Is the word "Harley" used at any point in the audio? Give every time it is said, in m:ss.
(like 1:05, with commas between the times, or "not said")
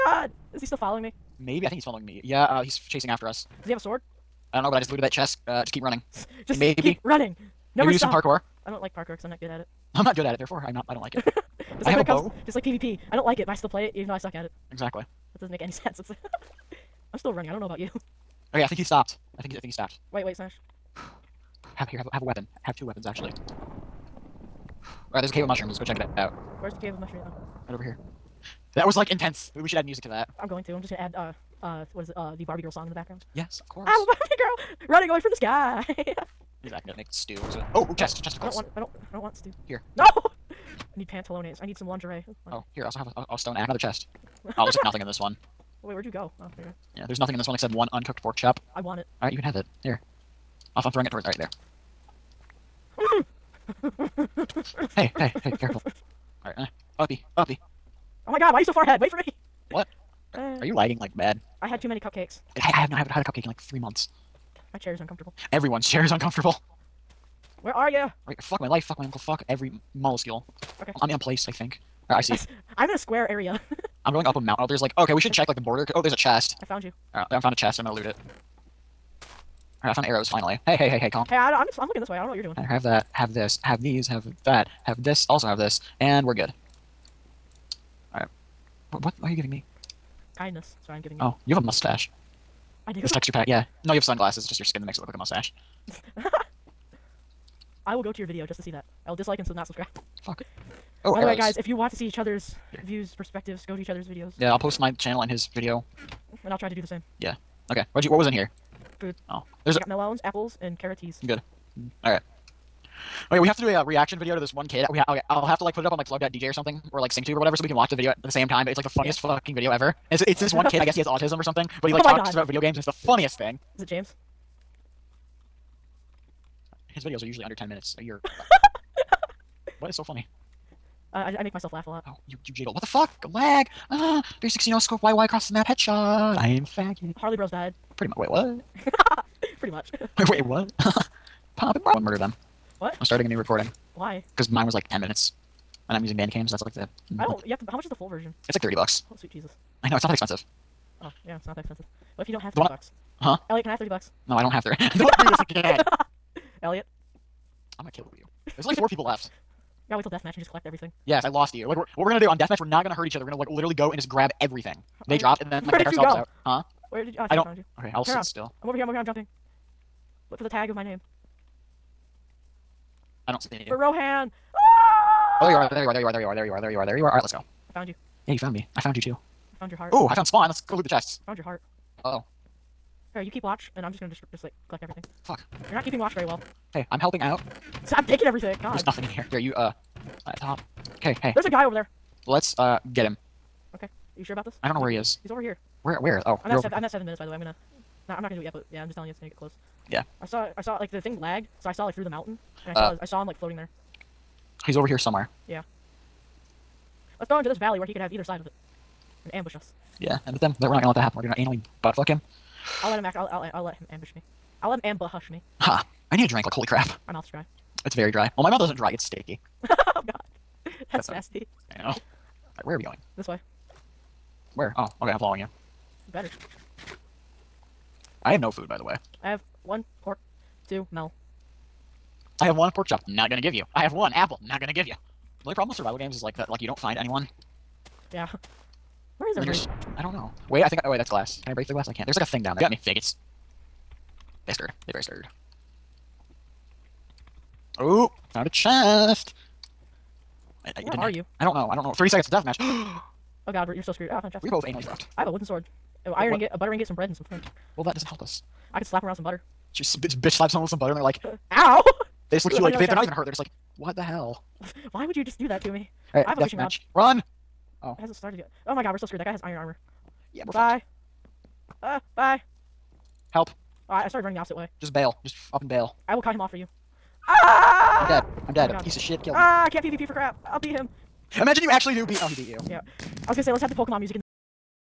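2:17.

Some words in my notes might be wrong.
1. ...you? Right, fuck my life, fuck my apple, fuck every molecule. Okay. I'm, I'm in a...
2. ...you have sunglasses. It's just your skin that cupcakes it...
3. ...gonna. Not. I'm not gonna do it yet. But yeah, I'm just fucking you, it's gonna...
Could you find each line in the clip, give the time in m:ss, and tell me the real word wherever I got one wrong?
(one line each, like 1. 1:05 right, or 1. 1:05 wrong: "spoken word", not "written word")
1. 1:07 wrong: "uncle", not "apple"
2. 1:33 wrong: "makes", not "cupcakes"
3. 3:17 wrong: "telling", not "fucking".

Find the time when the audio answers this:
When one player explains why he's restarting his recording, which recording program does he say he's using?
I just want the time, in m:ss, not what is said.
2:26.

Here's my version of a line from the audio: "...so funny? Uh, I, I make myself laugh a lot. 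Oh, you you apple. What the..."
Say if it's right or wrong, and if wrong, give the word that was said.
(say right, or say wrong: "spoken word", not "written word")
wrong: "jiggle", not "apple".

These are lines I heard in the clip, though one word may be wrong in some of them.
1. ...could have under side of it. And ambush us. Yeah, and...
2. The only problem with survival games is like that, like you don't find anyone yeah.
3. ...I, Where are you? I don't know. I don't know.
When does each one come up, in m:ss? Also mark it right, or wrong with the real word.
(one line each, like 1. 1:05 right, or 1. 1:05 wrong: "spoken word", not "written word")
1. 3:27 wrong: "either", not "under"
2. 3:55 right
3. 4:10 right.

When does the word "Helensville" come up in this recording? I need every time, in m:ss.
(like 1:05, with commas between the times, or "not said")
not said.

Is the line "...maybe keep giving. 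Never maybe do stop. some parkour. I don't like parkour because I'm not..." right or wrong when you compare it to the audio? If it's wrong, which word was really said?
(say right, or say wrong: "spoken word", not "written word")
wrong: "running", not "giving".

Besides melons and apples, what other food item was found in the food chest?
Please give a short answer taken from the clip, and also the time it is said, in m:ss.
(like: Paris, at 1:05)
carrots, at 1:50.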